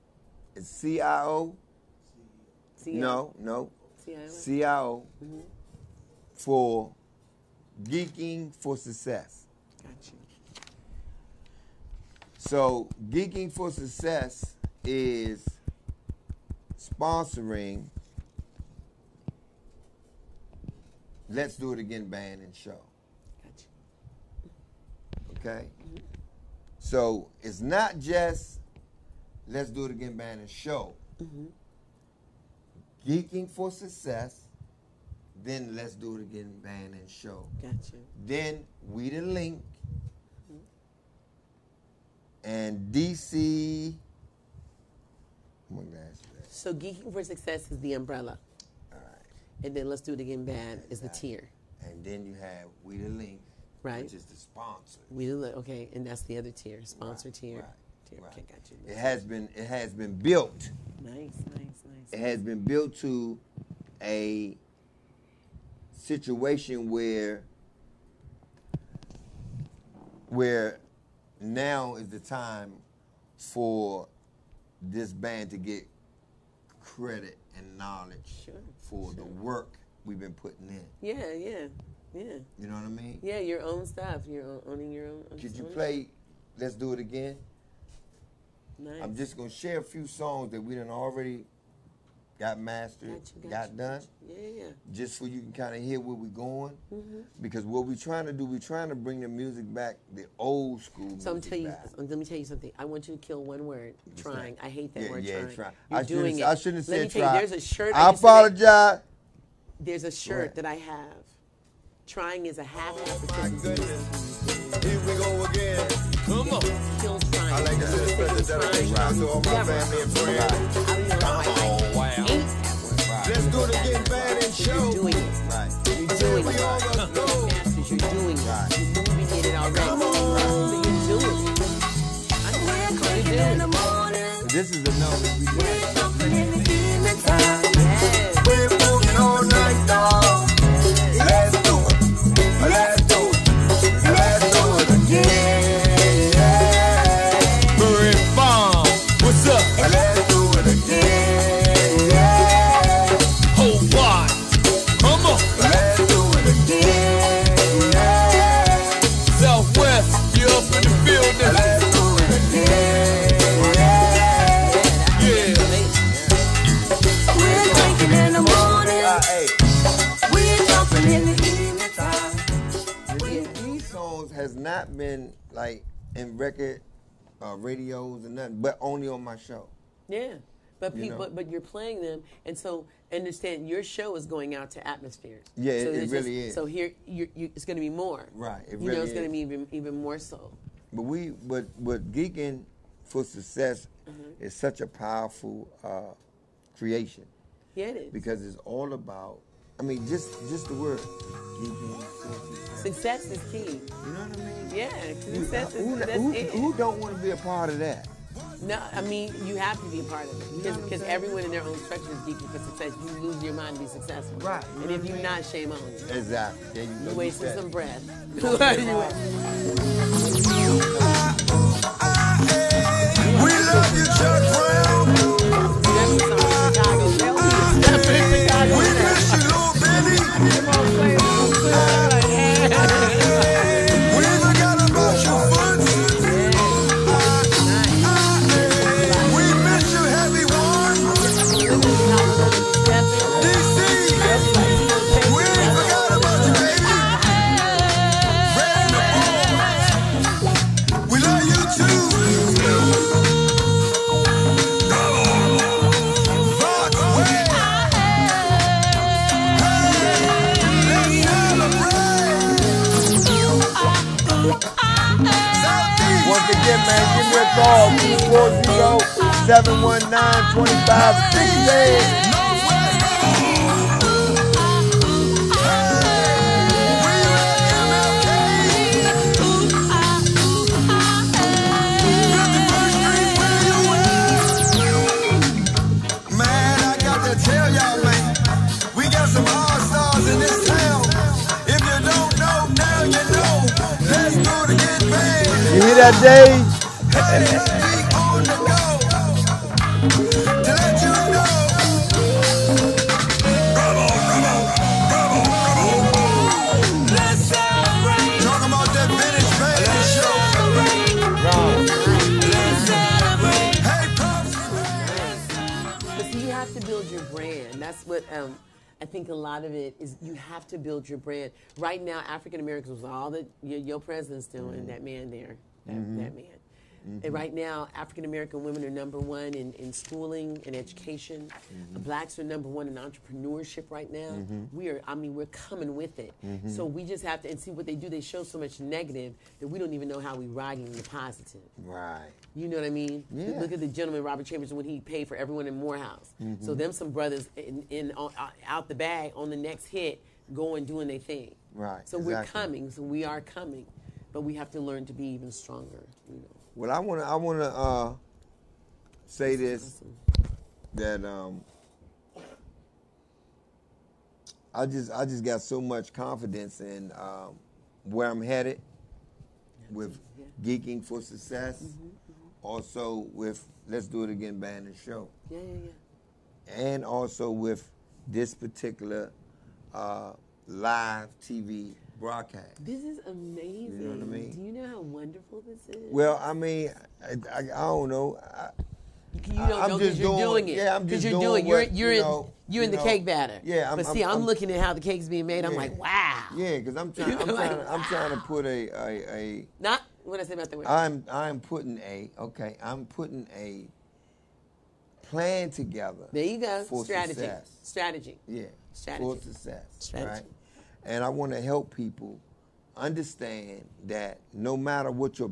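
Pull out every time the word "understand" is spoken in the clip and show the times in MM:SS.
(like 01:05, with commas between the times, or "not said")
03:03, 06:52.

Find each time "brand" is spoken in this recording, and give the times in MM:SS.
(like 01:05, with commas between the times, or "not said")
05:21.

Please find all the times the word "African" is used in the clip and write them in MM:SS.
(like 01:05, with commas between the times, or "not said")
05:22, 05:27.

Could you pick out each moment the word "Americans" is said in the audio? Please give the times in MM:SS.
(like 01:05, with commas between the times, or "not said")
05:22, 05:28.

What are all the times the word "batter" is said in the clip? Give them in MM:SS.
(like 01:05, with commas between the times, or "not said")
06:33.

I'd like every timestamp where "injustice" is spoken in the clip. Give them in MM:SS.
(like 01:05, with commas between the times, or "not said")
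not said.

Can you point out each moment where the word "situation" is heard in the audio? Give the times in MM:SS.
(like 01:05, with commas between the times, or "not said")
01:05.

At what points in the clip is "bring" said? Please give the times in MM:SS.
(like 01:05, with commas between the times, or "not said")
01:38.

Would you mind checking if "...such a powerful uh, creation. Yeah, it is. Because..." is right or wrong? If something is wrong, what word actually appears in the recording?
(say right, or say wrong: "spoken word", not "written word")
right.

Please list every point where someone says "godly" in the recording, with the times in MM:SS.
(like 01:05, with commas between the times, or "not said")
not said.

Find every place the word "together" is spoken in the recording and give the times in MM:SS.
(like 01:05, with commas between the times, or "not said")
06:45.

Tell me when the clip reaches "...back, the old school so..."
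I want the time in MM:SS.
01:39.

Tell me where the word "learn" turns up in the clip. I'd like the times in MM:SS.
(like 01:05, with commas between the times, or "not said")
05:54.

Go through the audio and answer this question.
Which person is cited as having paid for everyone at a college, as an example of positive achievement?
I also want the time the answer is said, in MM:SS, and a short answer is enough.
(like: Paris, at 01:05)
Robert Chambers, at 05:44.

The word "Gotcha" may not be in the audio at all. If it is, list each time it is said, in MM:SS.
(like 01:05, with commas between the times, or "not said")
00:09, 00:23, 00:37.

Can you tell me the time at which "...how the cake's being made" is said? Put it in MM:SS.
06:34.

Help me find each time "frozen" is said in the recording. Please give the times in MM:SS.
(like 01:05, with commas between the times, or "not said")
not said.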